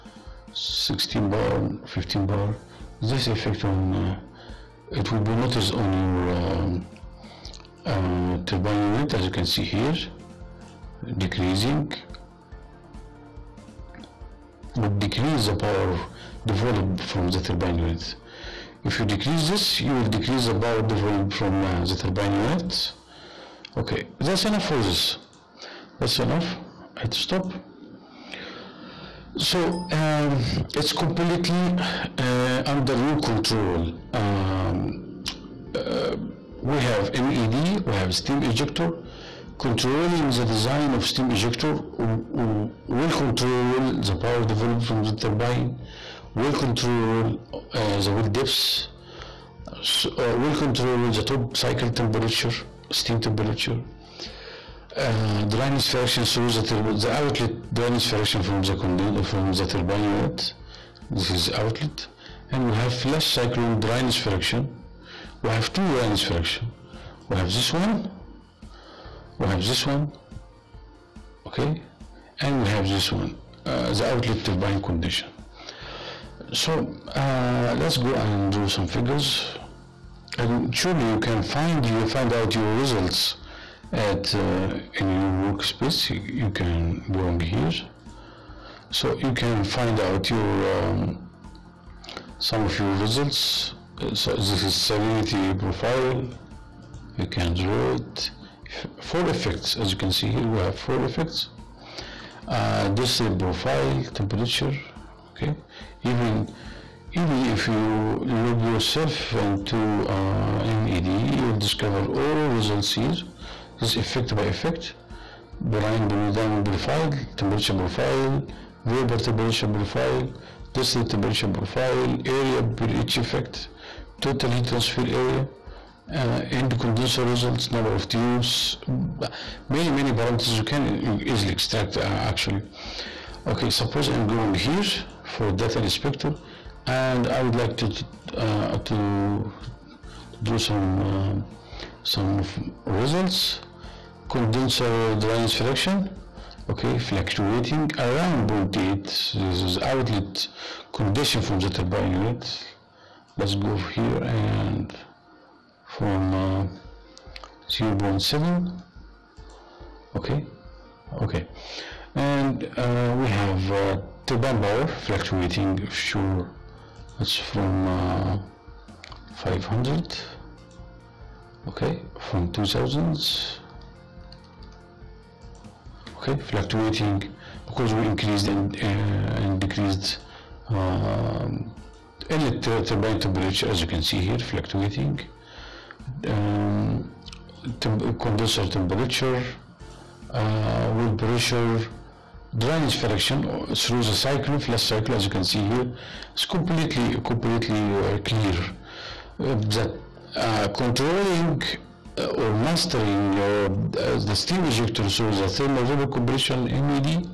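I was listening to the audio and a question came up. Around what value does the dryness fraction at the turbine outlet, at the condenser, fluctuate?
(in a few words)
0.8.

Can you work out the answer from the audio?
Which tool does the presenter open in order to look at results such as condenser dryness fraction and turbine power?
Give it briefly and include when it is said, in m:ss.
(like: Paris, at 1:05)
Data inspector, at 2:15.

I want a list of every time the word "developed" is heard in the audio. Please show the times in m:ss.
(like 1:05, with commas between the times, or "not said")
0:16, 0:20, 0:44.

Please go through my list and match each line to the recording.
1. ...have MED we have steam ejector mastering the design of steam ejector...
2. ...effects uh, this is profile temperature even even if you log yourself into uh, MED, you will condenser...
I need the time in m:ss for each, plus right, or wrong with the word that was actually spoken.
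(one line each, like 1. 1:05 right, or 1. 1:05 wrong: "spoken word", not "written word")
1. 0:36 wrong: "controlling", not "mastering"
2. 1:41 wrong: "discover", not "condenser".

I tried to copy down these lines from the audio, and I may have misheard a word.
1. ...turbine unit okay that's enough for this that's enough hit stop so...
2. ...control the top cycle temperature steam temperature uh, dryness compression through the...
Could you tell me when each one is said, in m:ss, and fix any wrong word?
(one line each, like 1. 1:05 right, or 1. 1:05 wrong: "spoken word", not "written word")
1. 0:21 right
2. 0:50 wrong: "fraction", not "compression".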